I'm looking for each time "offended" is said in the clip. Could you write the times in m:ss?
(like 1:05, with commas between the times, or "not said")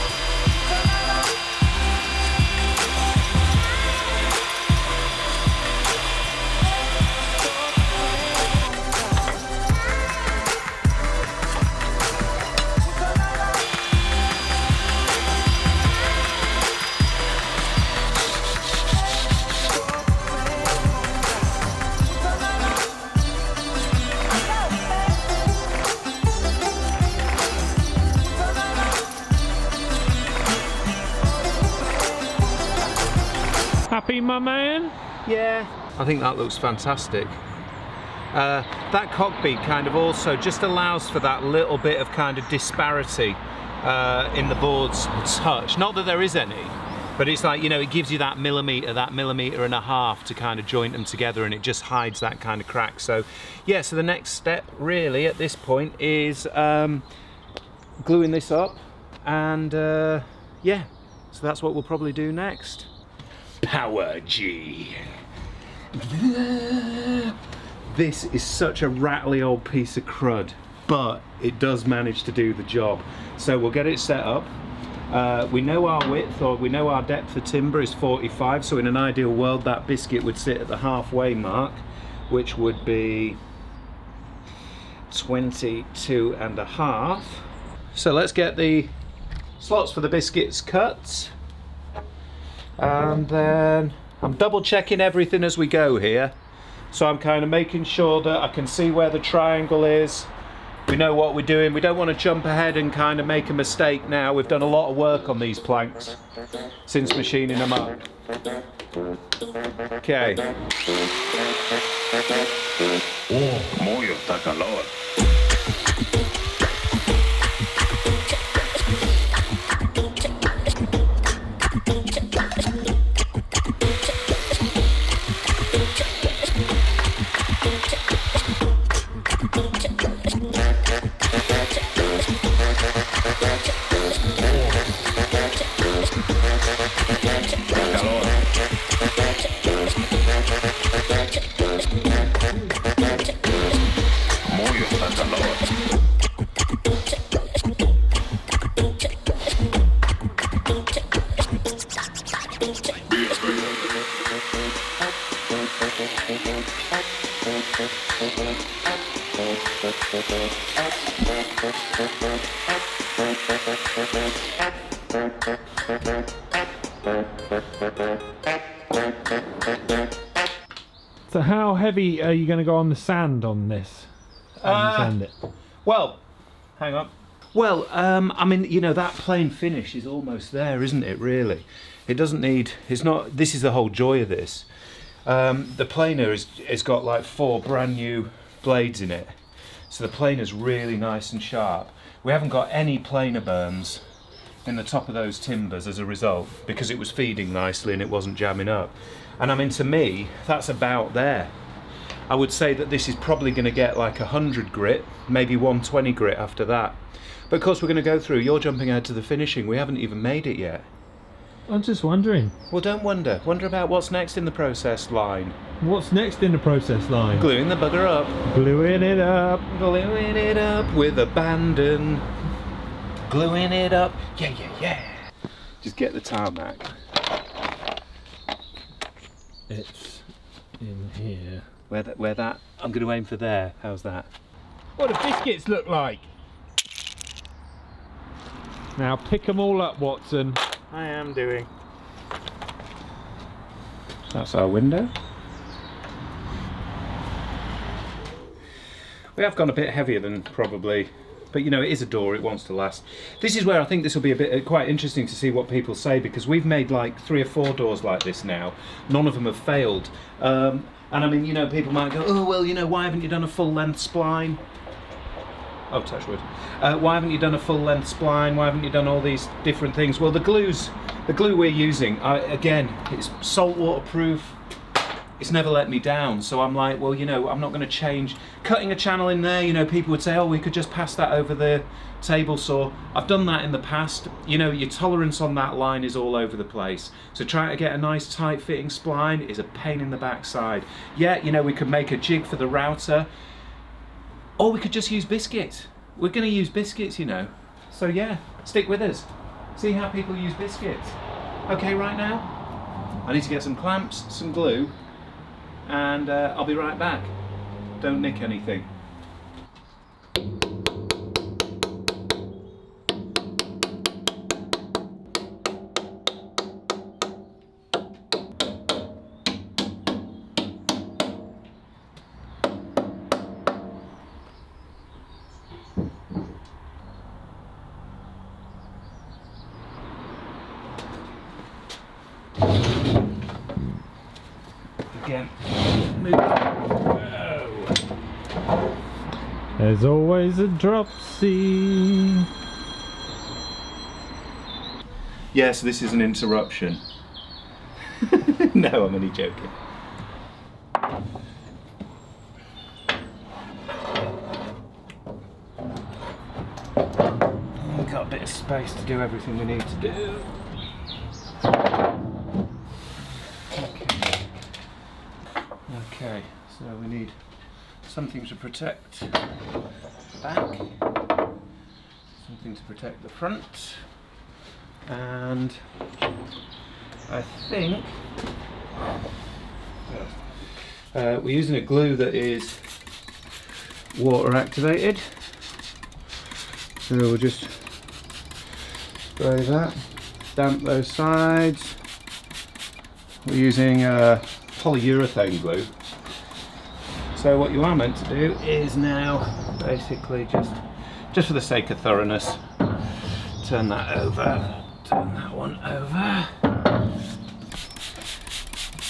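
not said.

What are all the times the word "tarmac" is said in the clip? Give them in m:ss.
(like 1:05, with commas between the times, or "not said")
3:46.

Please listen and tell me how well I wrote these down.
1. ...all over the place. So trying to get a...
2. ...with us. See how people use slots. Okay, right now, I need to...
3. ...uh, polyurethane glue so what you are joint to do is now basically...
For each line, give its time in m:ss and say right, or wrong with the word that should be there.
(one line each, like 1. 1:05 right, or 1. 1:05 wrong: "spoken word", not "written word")
1. 4:46 right
2. 4:58 wrong: "biscuits", not "slots"
3. 6:34 wrong: "meant", not "joint".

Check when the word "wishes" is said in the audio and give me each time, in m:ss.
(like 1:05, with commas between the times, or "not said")
not said.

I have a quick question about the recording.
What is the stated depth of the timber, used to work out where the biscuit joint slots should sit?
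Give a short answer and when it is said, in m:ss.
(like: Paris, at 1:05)
45, at 1:17.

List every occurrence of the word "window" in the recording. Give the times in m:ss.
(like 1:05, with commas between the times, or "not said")
4:04.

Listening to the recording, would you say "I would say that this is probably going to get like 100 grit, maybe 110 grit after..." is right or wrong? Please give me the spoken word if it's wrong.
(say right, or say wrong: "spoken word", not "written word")
wrong: "120", not "110".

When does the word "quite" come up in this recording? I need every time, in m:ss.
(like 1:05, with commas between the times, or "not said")
4:14.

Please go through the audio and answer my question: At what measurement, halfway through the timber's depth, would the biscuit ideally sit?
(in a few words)
22.5.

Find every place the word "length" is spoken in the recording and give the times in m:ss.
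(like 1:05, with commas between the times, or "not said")
4:23, 4:27.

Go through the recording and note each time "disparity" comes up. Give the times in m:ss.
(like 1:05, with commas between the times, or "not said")
0:42.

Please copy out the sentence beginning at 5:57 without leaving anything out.
We've got a bit of space to do everything we need to do.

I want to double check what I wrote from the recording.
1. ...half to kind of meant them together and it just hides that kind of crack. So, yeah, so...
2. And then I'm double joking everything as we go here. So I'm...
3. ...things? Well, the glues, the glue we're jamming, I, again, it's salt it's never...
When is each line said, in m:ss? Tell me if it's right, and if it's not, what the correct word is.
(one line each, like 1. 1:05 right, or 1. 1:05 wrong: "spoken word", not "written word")
1. 0:49 wrong: "joint", not "meant"
2. 1:32 wrong: "checking", not "joking"
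3. 4:29 wrong: "using", not "jamming".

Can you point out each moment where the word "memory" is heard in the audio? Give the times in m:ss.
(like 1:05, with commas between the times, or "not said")
not said.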